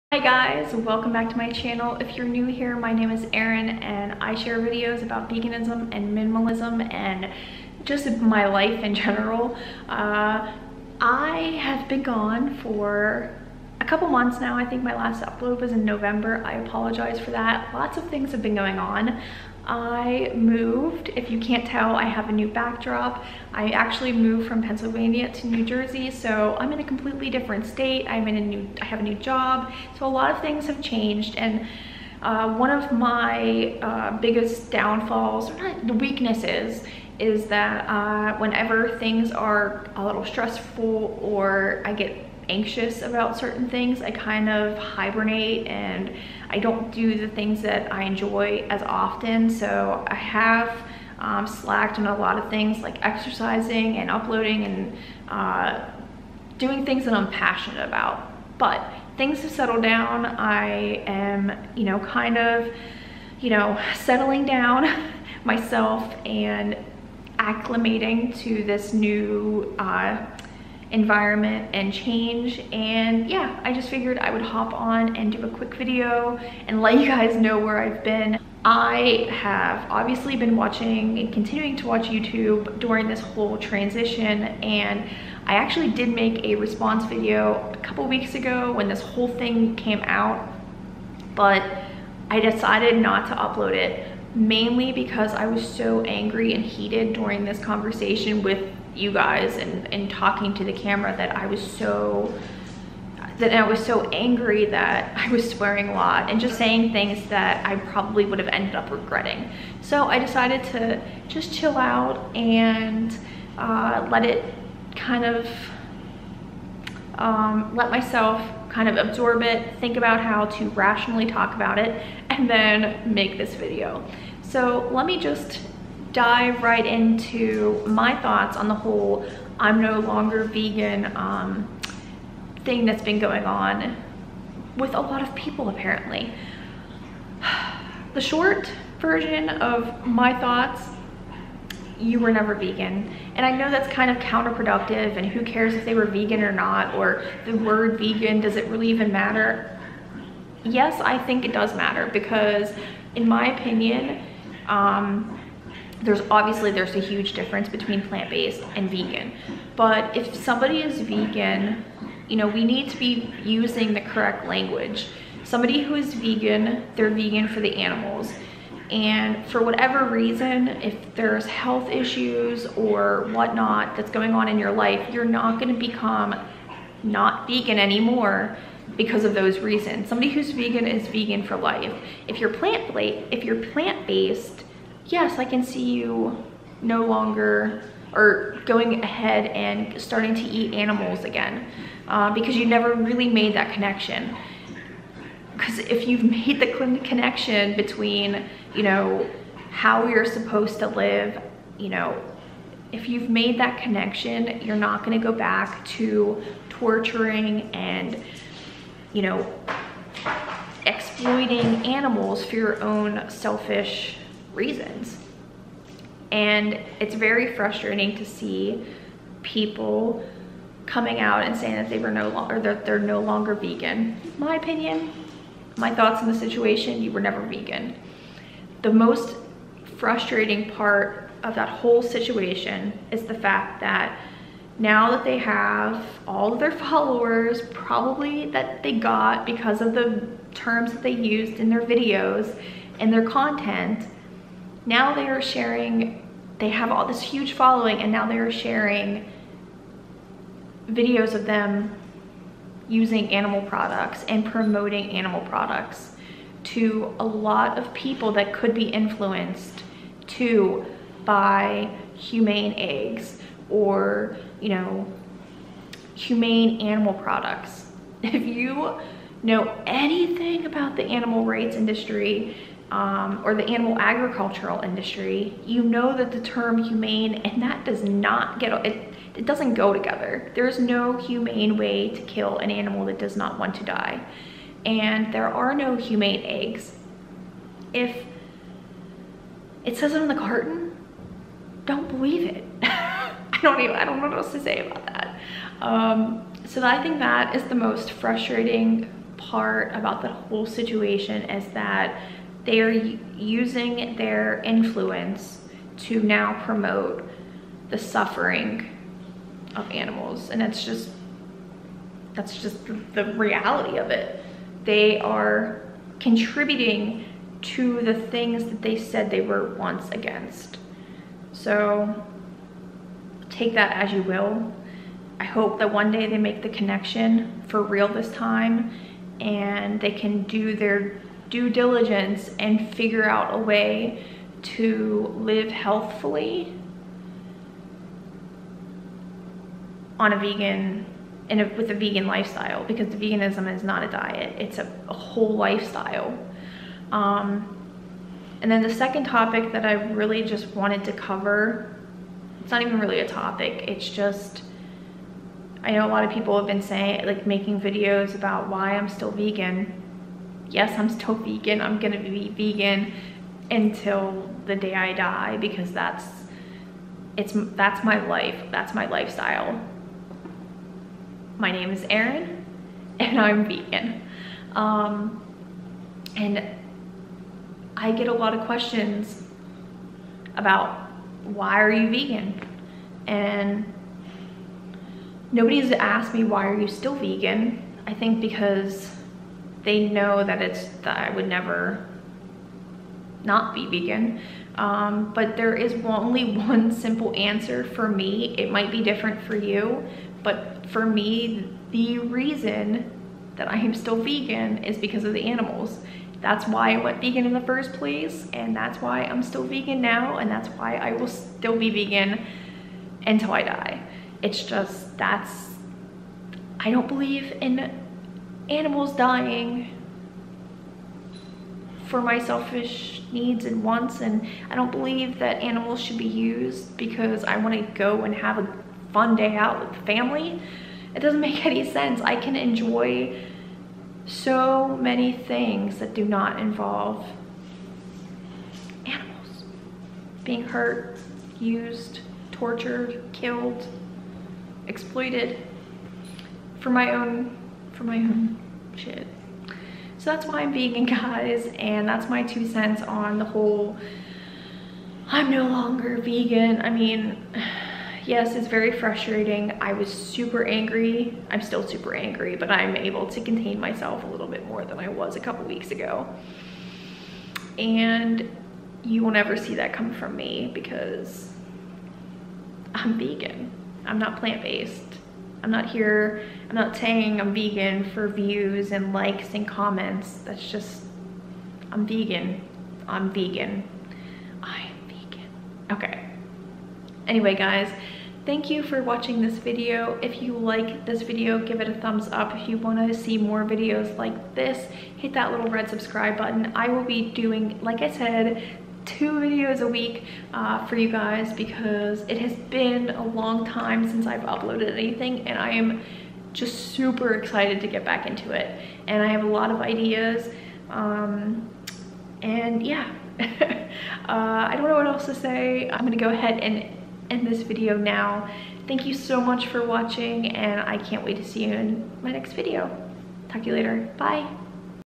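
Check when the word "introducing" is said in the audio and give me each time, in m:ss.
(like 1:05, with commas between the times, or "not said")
not said.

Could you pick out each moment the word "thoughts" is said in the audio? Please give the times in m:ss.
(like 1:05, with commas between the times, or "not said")
2:08, 2:20, 3:45.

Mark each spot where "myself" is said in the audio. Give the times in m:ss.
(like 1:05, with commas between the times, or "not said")
1:05, 1:57, 7:43.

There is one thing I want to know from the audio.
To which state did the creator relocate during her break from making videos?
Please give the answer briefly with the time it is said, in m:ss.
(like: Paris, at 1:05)
New Jersey, at 0:25.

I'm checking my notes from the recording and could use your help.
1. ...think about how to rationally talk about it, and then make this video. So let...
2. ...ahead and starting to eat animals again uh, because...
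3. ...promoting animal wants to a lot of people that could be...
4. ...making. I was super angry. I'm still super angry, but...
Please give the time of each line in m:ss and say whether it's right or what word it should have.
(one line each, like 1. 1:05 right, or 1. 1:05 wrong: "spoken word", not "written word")
1. 1:59 right
2. 3:09 right
3. 4:14 wrong: "products", not "wants"
4. 7:38 wrong: "frustrating", not "making".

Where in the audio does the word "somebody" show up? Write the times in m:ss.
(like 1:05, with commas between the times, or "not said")
2:40, 2:45, 3:00.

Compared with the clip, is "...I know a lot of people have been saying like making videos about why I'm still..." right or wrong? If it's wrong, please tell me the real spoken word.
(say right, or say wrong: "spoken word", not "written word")
right.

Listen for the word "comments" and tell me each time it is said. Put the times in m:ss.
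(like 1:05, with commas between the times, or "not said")
7:59.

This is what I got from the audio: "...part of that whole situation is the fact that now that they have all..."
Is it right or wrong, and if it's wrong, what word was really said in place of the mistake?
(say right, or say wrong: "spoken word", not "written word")
right.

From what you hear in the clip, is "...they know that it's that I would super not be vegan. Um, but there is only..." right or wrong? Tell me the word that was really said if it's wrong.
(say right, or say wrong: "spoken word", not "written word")
wrong: "never", not "super".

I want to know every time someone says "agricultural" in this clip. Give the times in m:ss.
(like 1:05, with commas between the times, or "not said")
4:33.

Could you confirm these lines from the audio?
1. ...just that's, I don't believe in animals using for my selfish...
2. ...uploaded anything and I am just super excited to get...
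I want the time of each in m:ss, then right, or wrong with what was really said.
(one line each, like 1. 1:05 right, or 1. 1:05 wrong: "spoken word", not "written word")
1. 6:54 wrong: "dying", not "using"
2. 8:24 right.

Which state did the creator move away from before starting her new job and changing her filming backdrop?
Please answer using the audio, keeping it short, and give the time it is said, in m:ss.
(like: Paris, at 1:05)
Pennsylvania, at 0:24.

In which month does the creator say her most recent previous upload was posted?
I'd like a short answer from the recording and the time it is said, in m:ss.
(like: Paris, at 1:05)
November, at 0:15.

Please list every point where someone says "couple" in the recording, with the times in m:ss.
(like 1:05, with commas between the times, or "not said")
0:13, 1:27, 7:45.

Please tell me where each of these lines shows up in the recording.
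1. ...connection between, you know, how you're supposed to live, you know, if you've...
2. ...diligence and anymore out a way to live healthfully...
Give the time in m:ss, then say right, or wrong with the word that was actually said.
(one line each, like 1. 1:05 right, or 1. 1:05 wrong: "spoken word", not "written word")
1. 3:17 right
2. 5:31 wrong: "figure", not "anymore".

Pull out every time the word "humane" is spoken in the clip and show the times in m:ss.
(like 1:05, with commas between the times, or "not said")
4:22, 4:26, 4:36, 4:41, 4:45.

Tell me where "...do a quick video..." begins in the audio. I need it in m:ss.
1:15.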